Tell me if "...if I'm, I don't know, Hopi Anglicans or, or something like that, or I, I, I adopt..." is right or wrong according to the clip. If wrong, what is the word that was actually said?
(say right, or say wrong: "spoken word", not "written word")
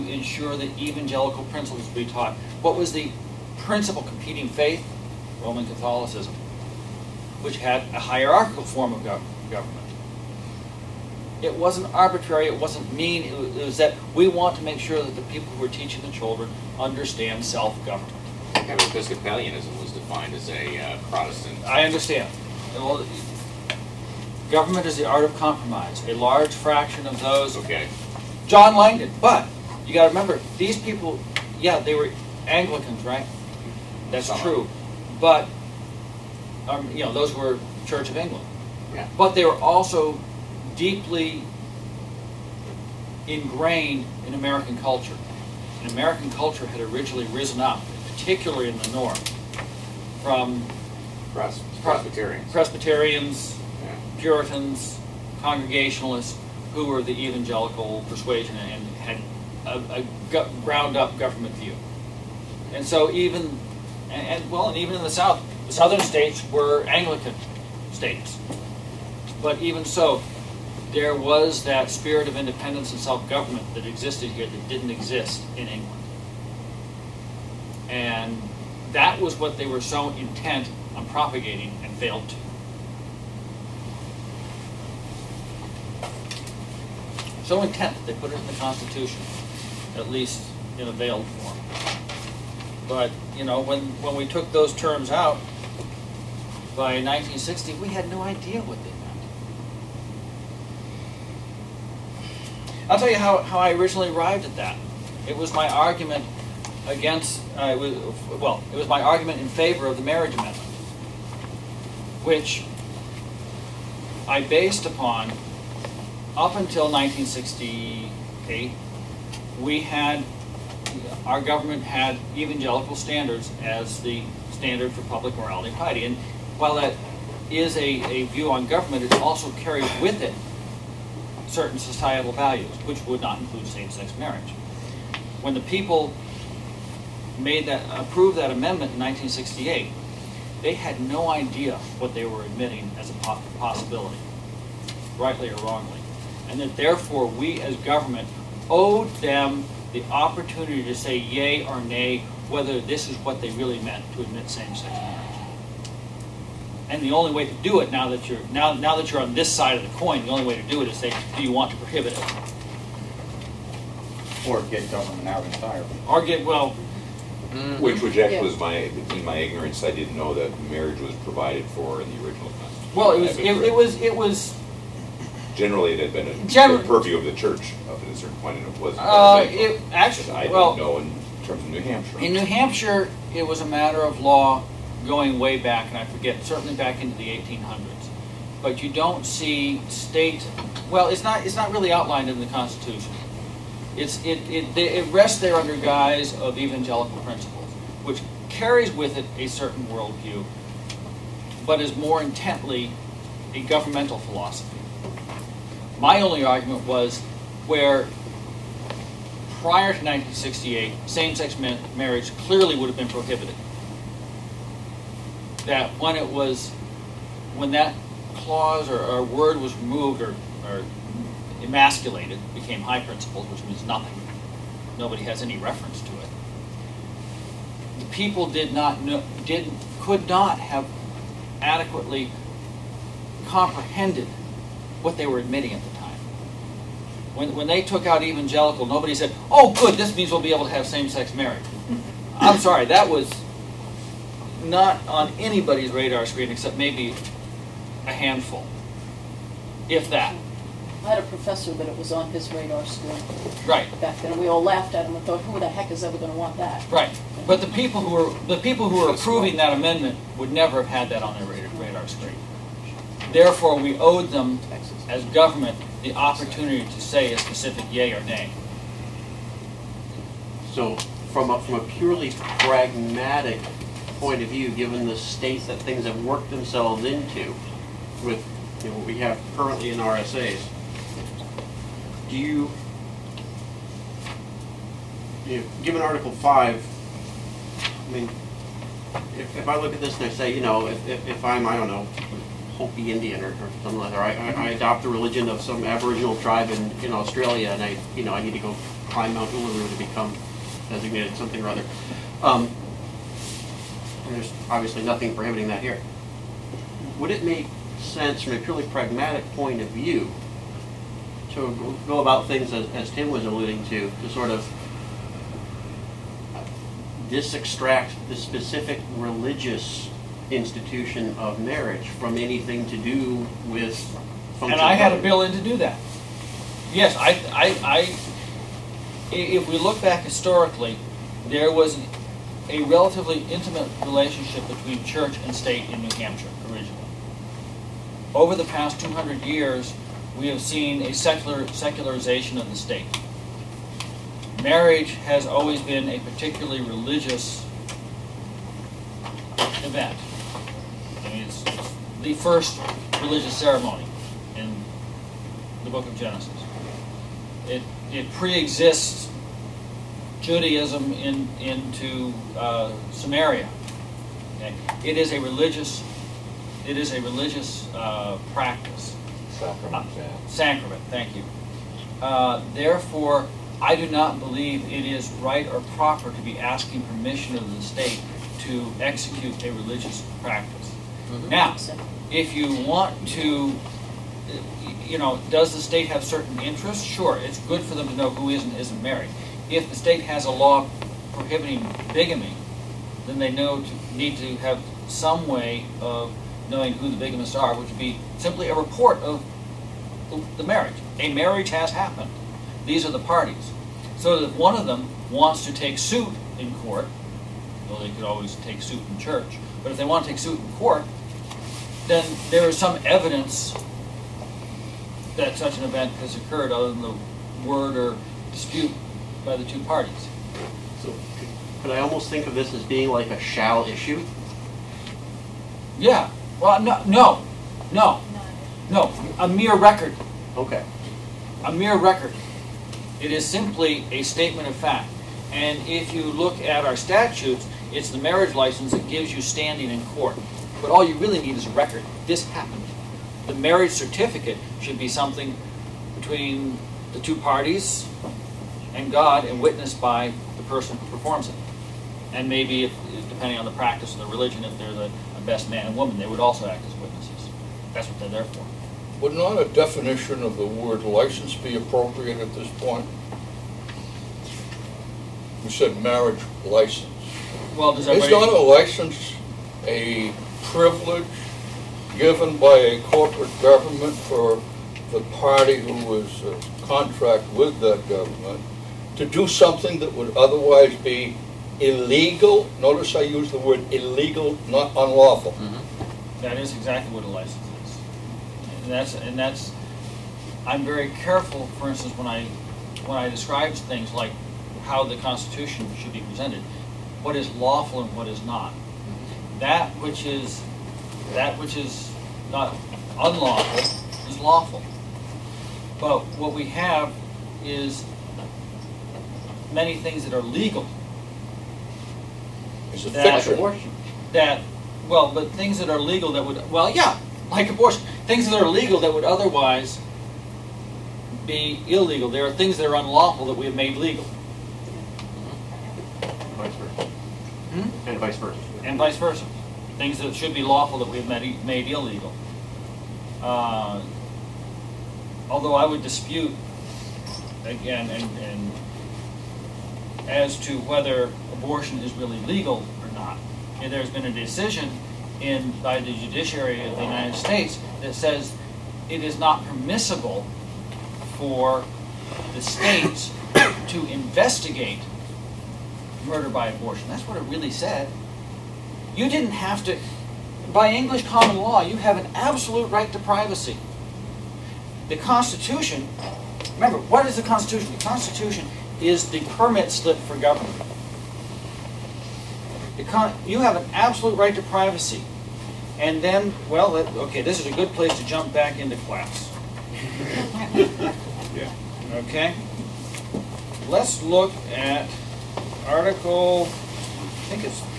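wrong: "Indian", not "Anglicans".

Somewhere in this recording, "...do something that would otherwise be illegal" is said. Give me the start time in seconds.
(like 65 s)
479 s.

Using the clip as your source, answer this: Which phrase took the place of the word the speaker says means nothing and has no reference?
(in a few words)
high principles.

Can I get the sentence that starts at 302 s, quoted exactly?
Um, and there's obviously nothing prohibiting that here.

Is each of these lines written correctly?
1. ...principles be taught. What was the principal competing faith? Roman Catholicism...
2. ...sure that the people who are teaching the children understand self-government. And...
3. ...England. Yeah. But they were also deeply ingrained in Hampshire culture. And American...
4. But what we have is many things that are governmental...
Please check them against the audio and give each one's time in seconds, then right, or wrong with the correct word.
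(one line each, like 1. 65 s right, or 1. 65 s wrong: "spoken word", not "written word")
1. 1 s right
2. 14 s right
3. 38 s wrong: "American", not "Hampshire"
4. 505 s wrong: "legal", not "governmental".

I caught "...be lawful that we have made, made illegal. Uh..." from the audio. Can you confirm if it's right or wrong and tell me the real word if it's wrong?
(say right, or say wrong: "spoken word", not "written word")
right.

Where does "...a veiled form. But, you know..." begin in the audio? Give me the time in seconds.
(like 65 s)
90 s.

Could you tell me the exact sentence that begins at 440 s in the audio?
But all you really need is a record.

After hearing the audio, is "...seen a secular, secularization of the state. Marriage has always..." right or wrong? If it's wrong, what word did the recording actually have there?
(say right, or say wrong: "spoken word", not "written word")
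right.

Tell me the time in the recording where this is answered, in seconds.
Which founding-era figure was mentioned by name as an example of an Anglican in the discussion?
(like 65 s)
28 s.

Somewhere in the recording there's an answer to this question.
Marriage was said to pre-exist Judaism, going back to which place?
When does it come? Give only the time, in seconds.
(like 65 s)
363 s.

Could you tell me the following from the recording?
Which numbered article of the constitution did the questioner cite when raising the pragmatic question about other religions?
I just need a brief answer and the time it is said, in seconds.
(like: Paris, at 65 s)
Article 5, at 286 s.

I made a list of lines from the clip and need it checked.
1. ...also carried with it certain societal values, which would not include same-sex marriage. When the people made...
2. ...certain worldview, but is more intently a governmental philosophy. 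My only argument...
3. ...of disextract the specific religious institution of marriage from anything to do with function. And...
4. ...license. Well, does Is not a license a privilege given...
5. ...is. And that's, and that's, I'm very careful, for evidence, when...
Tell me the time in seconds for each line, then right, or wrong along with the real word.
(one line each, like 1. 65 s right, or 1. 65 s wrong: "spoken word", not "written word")
1. 129 s right
2. 199 s right
3. 314 s right
4. 466 s right
5. 487 s wrong: "instance", not "evidence".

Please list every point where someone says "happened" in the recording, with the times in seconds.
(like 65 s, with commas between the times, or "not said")
401 s, 442 s.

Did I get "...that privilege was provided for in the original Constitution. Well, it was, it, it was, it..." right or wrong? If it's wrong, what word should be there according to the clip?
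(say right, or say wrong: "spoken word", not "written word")
wrong: "marriage", not "privilege".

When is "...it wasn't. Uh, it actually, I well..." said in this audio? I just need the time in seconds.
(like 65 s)
178 s.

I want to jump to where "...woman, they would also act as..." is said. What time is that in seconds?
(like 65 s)
455 s.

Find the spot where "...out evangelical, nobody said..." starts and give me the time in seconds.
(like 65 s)
238 s.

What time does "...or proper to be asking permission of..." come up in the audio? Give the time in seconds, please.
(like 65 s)
375 s.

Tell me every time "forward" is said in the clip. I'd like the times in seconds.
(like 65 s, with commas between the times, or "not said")
not said.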